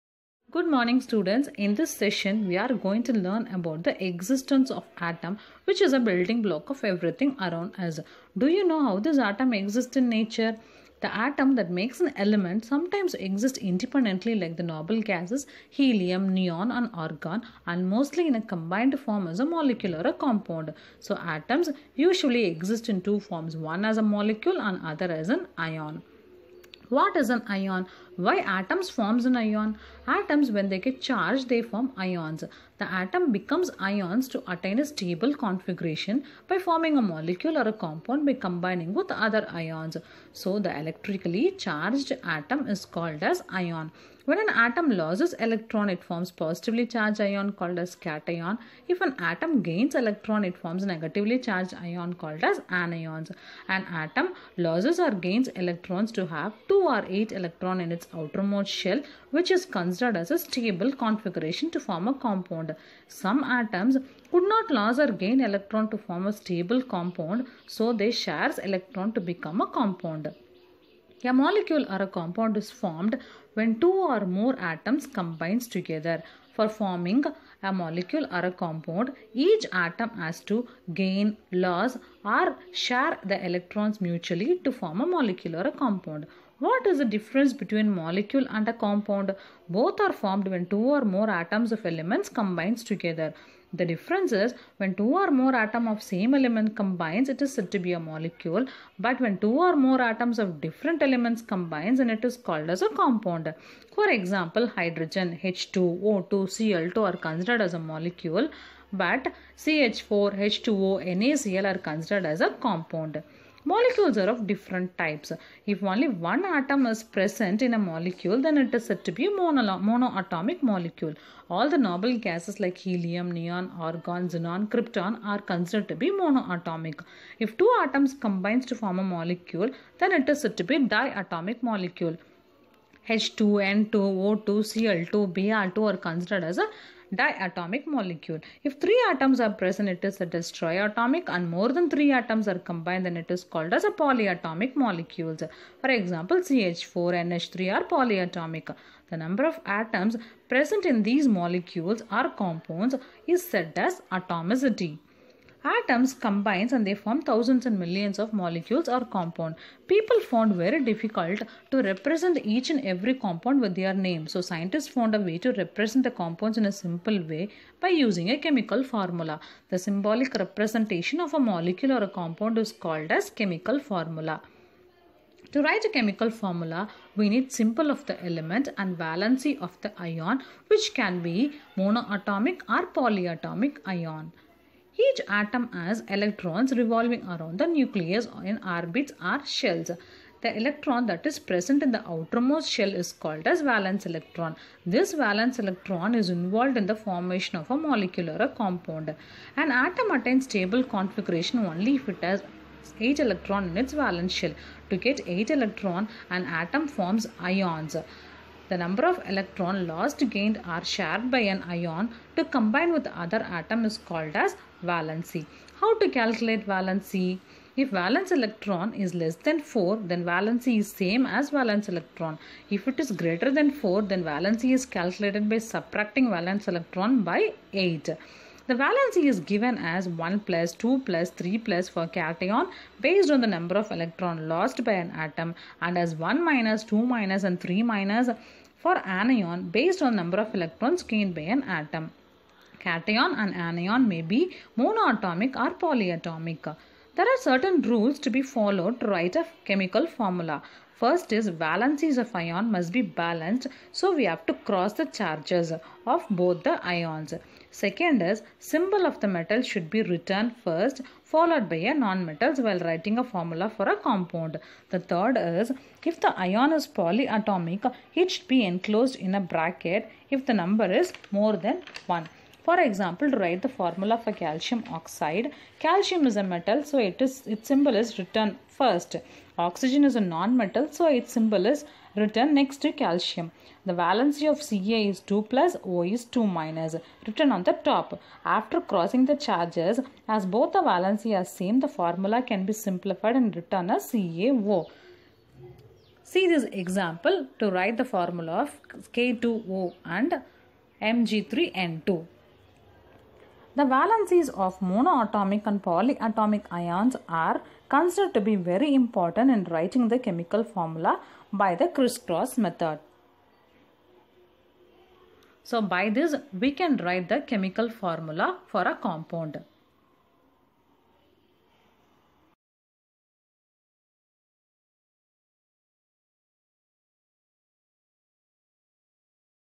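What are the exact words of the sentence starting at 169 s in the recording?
The symbolic representation of a molecule or a compound is called as chemical formula.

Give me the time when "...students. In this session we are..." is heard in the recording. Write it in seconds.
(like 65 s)
1 s.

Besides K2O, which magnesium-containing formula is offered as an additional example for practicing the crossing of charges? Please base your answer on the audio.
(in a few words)
Mg3N2.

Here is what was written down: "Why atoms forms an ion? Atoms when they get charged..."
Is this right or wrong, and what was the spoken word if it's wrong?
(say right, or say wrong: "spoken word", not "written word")
right.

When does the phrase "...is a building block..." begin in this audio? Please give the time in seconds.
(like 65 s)
5 s.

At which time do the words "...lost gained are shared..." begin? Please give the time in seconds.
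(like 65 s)
209 s.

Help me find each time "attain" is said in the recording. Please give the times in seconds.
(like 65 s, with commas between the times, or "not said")
34 s, 200 s.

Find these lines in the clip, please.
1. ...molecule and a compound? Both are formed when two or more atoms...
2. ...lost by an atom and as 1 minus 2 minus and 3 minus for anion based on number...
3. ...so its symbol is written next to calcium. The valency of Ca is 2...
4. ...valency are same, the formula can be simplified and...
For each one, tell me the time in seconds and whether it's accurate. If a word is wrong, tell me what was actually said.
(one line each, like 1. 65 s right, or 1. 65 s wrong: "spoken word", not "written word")
1. 87 s right
2. 234 s right
3. 280 s right
4. 290 s right.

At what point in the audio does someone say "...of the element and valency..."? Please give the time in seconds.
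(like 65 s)
177 s.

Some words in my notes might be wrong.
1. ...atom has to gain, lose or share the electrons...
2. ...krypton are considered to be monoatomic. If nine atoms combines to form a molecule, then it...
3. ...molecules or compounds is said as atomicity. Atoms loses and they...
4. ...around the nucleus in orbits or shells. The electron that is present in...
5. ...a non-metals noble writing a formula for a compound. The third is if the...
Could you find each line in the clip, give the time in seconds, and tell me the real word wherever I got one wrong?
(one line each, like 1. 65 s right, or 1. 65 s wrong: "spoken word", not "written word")
1. 79 s right
2. 124 s wrong: "two", not "nine"
3. 151 s wrong: "combines", not "loses"
4. 187 s right
5. 261 s wrong: "while", not "noble".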